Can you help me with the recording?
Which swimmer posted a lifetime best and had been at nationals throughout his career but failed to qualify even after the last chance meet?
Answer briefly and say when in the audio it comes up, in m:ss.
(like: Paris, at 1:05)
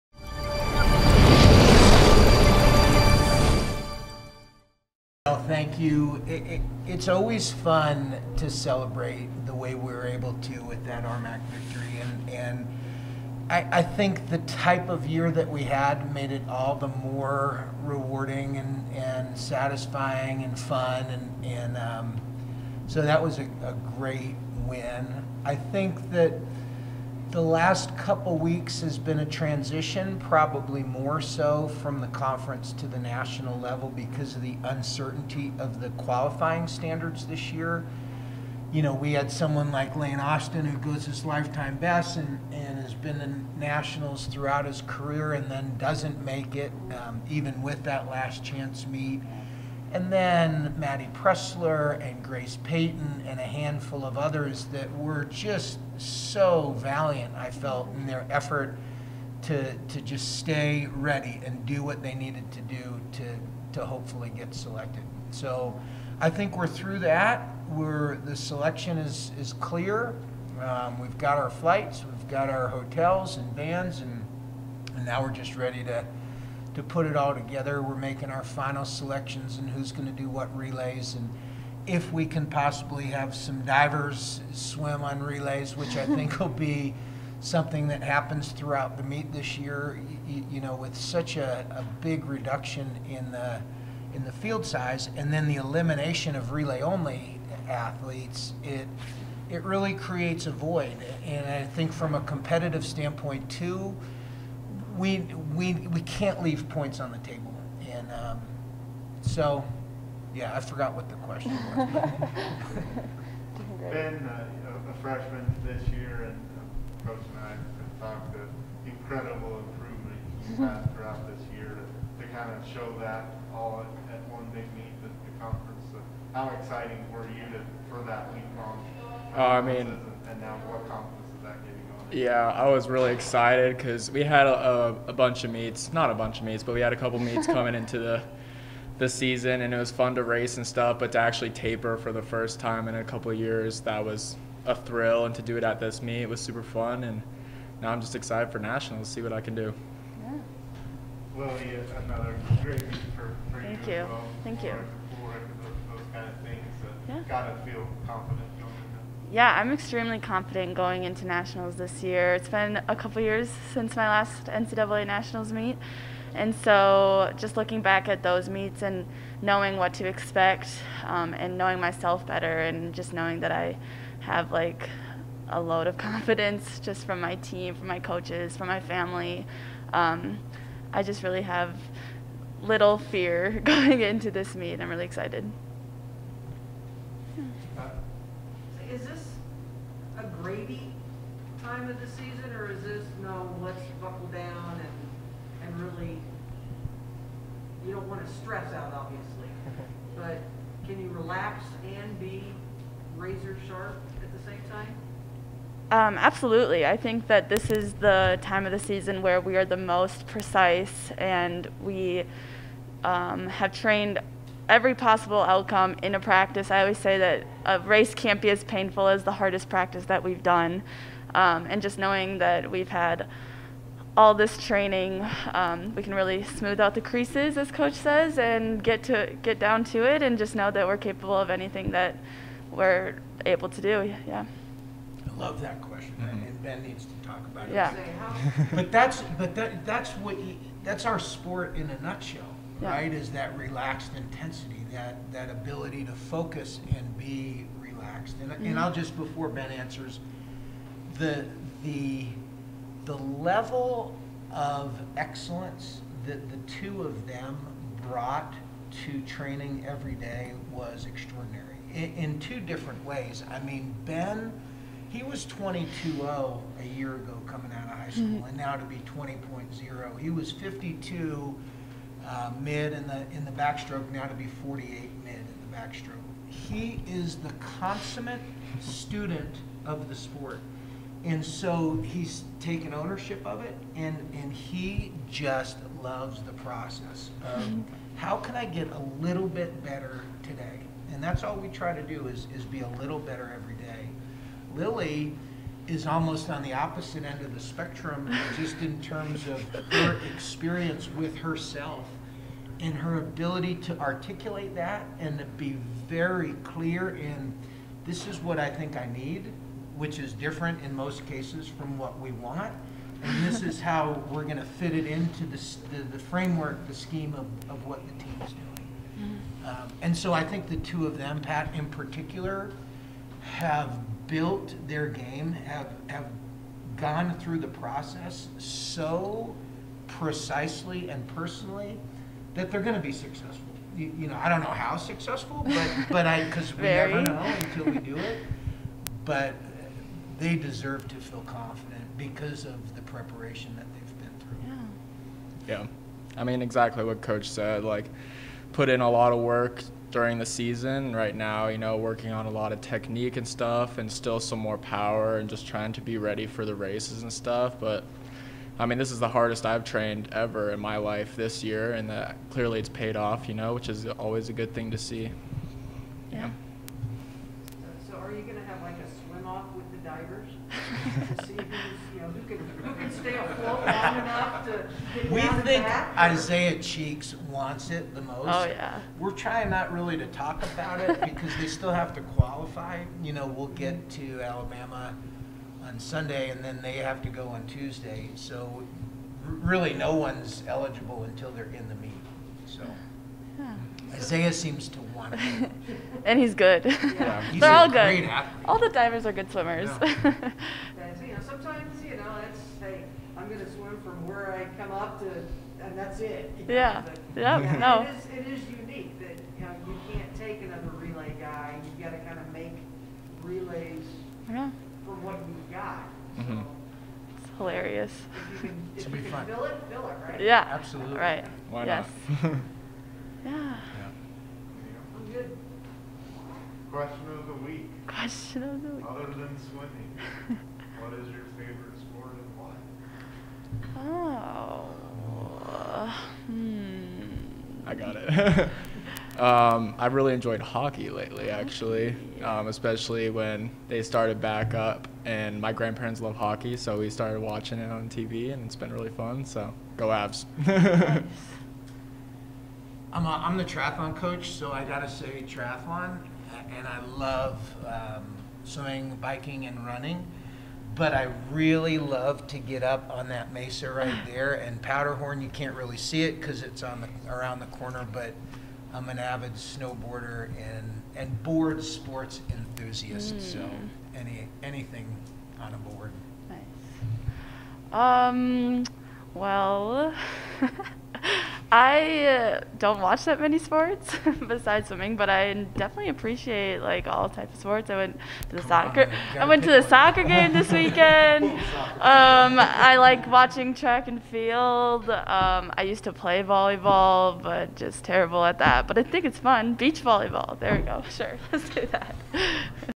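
Lane Austin, at 0:39.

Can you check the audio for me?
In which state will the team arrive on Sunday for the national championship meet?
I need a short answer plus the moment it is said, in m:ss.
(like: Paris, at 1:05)
Alabama, at 6:24.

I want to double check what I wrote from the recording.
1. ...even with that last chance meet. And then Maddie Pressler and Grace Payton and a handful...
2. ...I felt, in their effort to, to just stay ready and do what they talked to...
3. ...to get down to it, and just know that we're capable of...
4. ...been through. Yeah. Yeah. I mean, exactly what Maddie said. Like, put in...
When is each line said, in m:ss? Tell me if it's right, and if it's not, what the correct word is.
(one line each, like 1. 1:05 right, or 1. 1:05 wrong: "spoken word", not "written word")
1. 0:47 right
2. 0:57 wrong: "needed", not "talked"
3. 3:49 right
4. 5:44 wrong: "Coach", not "Maddie".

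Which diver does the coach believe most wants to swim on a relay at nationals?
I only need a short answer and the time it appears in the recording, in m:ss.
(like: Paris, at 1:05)
Isaiah Cheeks, at 6:16.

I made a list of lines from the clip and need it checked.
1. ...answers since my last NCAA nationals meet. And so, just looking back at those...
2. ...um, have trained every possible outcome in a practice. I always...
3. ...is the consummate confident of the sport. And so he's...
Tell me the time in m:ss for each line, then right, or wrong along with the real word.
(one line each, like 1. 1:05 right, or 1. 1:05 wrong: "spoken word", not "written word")
1. 2:43 wrong: "years", not "answers"
2. 3:33 right
3. 4:37 wrong: "student", not "confident".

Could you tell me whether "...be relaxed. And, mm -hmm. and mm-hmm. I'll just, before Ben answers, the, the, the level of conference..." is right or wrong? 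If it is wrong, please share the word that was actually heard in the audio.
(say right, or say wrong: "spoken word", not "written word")
wrong: "excellence", not "conference".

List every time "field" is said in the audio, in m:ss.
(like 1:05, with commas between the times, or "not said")
1:34, 8:14.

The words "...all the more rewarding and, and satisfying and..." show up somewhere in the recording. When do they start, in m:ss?
0:16.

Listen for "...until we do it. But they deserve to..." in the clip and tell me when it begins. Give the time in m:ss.
5:37.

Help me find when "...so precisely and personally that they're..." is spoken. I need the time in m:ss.
5:28.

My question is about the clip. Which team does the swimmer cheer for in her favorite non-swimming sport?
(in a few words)
Avs.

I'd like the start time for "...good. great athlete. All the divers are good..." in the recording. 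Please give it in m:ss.
6:37.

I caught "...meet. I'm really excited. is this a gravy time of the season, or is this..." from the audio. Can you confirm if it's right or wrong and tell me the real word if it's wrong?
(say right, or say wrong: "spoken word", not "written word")
right.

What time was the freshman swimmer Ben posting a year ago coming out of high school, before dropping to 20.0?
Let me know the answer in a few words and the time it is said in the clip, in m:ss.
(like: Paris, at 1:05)
22.0, at 4:25.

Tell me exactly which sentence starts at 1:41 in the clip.
And I think from a competitive standpoint too we, we, we can't leave points on the table.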